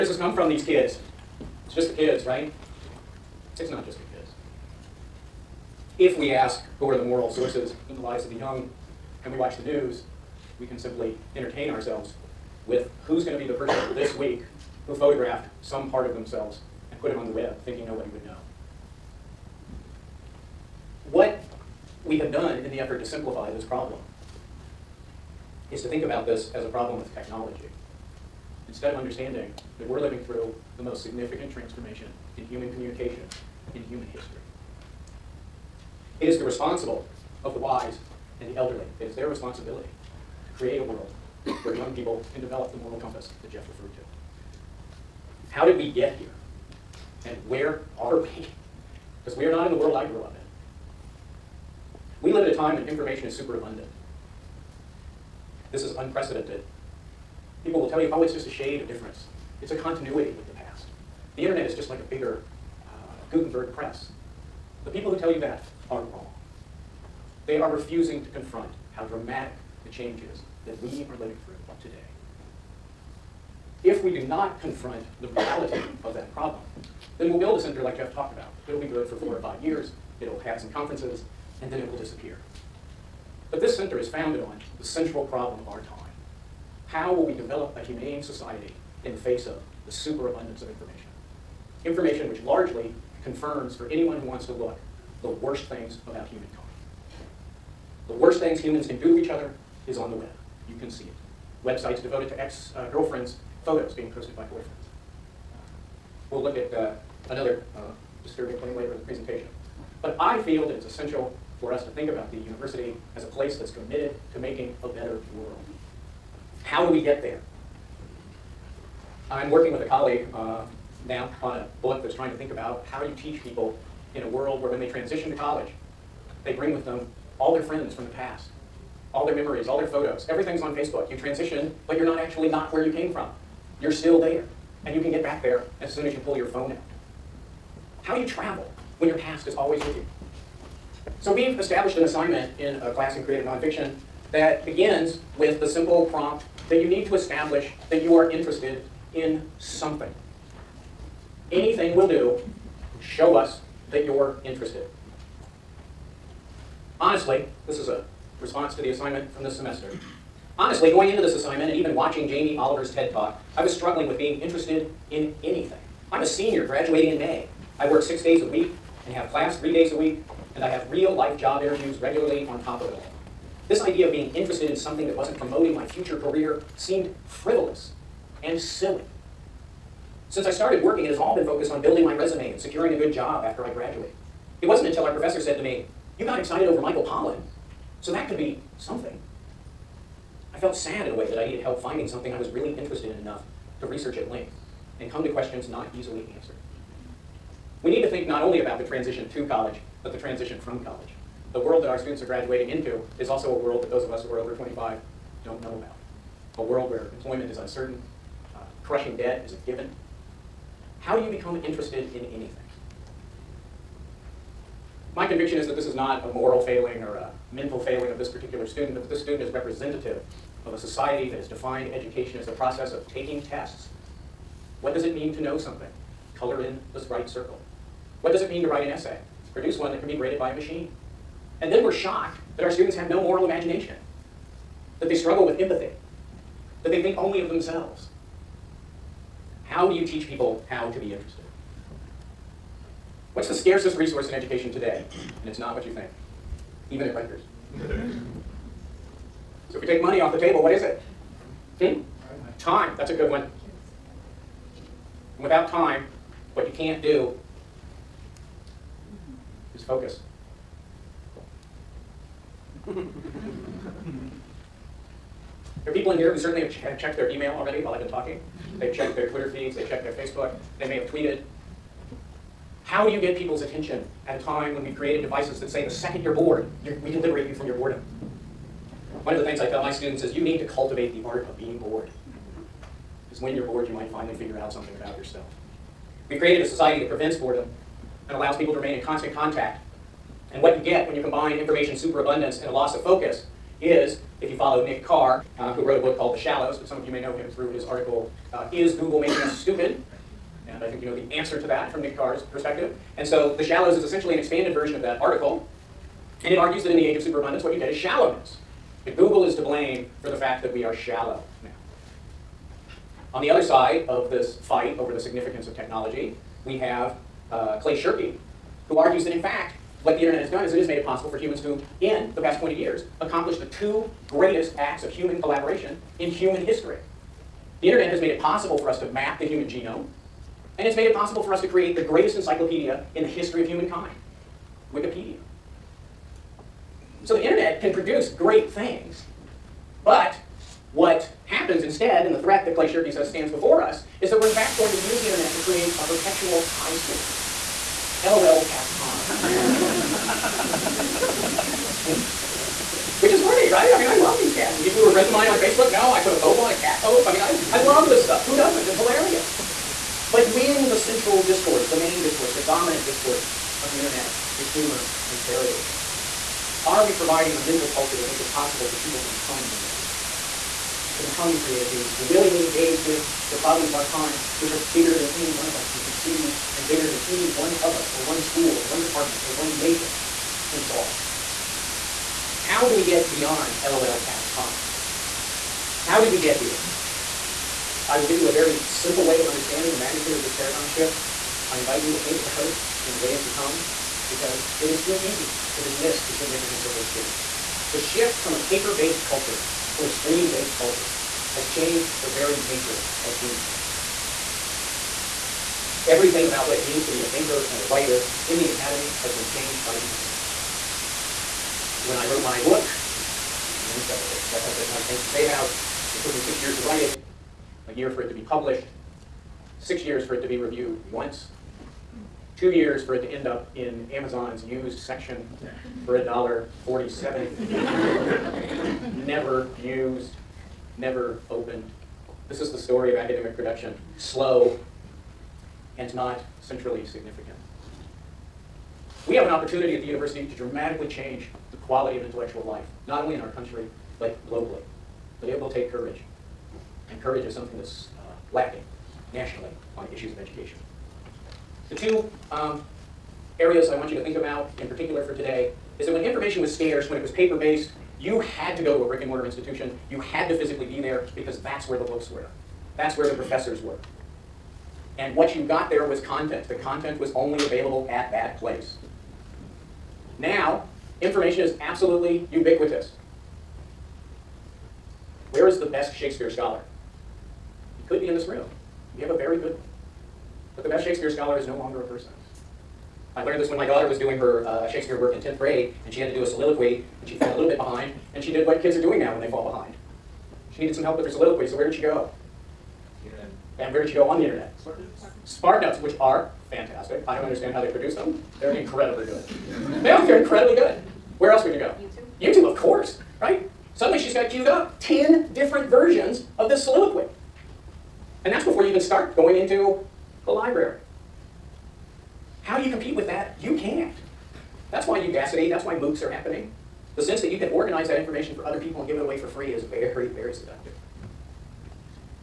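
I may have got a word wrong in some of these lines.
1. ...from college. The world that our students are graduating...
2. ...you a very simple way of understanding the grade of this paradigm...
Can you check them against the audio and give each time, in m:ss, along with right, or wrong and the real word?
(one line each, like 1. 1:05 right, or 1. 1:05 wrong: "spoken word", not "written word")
1. 3:20 right
2. 6:28 wrong: "magnitude", not "grade".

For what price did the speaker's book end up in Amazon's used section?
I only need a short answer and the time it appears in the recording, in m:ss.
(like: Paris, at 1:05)
$1.47, at 7:06.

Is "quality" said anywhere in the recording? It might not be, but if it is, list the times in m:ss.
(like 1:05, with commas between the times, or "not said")
7:21.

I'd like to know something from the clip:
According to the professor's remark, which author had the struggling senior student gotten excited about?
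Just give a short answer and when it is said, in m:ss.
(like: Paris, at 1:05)
Michael Pollan, at 3:06.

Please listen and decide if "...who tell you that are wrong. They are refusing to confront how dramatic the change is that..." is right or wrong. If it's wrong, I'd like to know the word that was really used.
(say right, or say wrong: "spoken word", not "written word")
right.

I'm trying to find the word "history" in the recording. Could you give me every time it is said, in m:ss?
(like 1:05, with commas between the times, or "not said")
0:34, 5:26, 5:33.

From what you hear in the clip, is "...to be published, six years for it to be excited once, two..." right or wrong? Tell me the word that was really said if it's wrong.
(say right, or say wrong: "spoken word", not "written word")
wrong: "reviewed", not "excited".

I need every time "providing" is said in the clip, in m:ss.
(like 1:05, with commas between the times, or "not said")
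6:07.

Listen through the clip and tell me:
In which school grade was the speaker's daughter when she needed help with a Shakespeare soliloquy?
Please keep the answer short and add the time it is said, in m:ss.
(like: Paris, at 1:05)
10th grade, at 8:05.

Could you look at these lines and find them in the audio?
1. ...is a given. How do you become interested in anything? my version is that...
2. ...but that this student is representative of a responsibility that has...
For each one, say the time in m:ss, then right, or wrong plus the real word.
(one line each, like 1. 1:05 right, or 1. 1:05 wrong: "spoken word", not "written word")
1. 3:29 wrong: "conviction", not "version"
2. 3:38 wrong: "society", not "responsibility".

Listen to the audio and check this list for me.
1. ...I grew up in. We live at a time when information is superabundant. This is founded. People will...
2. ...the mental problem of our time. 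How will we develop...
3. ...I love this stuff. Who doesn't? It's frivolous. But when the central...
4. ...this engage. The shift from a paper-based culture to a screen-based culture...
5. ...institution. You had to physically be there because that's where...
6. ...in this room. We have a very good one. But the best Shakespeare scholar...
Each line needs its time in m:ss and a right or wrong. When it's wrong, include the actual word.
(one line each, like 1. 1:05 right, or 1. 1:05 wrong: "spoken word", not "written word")
1. 0:49 wrong: "unprecedented", not "founded"
2. 1:24 wrong: "central", not "mental"
3. 5:57 wrong: "hilarious", not "frivolous"
4. 6:36 wrong: "change", not "engage"
5. 7:39 right
6. 7:58 right.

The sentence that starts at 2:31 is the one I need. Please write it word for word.
Anything will do, show us that you're interested.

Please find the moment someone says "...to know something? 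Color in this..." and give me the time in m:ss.
3:45.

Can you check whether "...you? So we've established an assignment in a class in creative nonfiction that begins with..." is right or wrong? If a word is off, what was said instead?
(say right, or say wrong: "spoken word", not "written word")
right.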